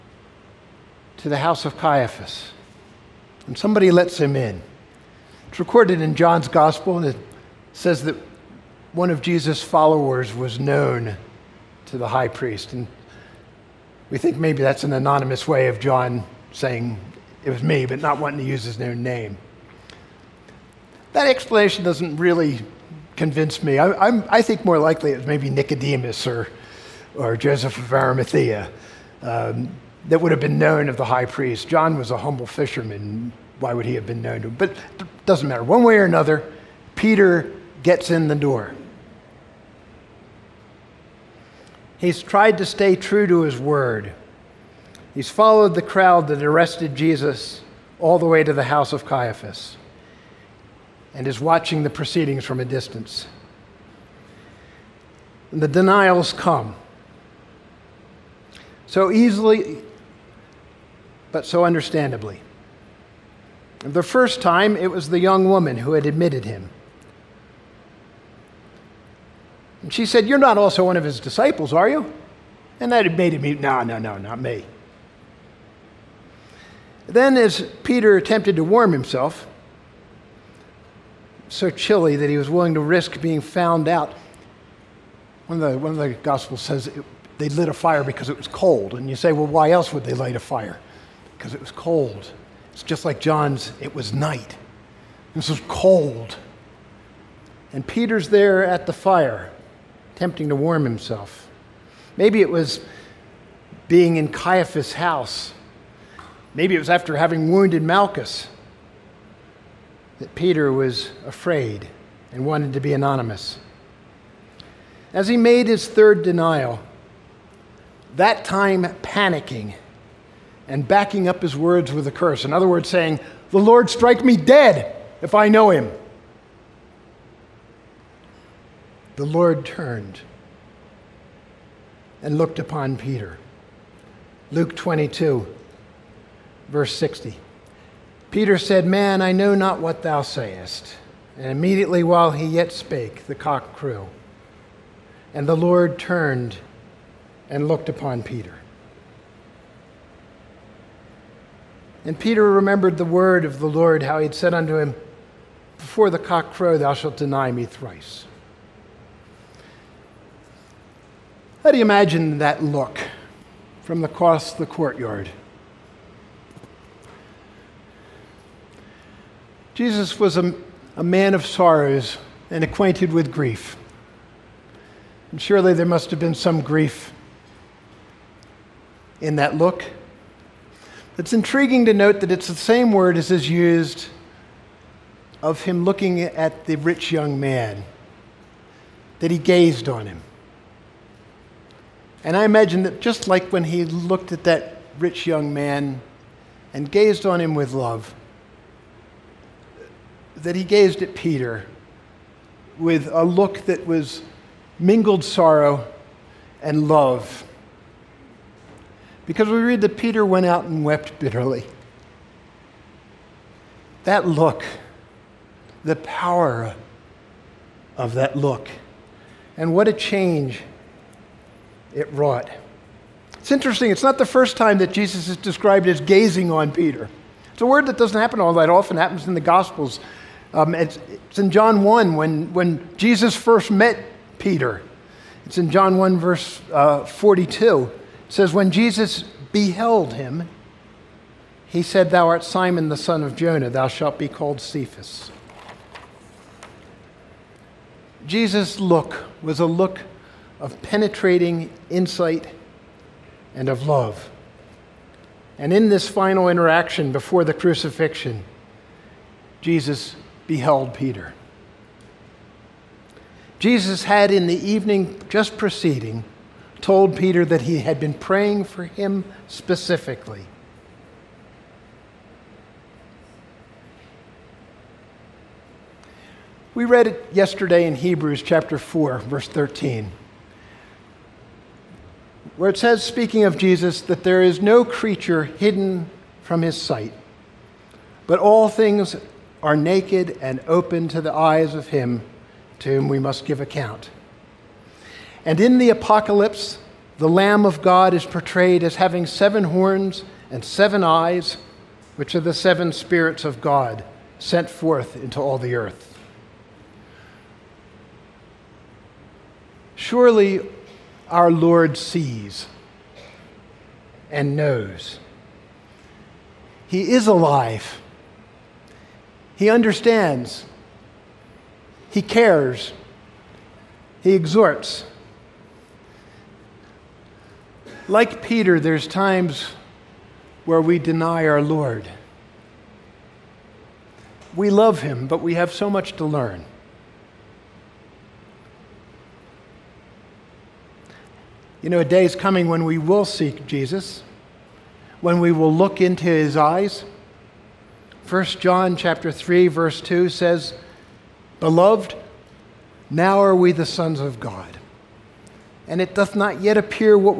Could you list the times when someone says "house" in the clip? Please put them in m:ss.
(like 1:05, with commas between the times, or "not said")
0:01, 0:48, 1:44.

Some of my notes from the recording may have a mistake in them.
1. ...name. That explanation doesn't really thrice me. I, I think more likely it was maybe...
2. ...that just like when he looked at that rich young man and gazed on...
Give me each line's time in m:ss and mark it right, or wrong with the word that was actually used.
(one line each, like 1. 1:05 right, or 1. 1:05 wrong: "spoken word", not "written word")
1. 0:19 wrong: "convince", not "thrice"
2. 3:12 right.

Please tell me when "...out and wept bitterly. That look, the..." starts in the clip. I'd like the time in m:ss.
3:30.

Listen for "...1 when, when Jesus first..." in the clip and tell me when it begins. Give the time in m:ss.
3:51.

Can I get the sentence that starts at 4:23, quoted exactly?
Jesus had, in the evening just preceding, told Peter that he had been praying for him specifically.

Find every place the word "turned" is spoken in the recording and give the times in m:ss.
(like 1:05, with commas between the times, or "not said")
2:09, 2:25.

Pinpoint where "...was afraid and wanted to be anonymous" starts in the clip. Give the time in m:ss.
1:50.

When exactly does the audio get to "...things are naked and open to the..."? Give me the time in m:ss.
4:48.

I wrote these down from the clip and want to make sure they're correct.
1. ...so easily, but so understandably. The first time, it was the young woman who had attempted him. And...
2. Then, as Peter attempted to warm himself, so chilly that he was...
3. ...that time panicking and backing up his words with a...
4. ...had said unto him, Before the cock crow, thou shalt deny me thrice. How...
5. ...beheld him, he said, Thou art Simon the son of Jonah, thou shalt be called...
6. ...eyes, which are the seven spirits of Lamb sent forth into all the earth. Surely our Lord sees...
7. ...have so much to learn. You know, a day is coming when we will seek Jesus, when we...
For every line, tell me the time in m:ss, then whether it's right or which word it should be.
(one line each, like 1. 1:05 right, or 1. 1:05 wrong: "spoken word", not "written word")
1. 0:58 wrong: "admitted", not "attempted"
2. 1:17 right
3. 1:58 right
4. 2:34 right
5. 3:59 right
6. 5:01 wrong: "God", not "Lamb"
7. 5:35 right.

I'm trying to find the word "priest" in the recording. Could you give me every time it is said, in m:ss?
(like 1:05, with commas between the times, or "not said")
0:12, 0:31.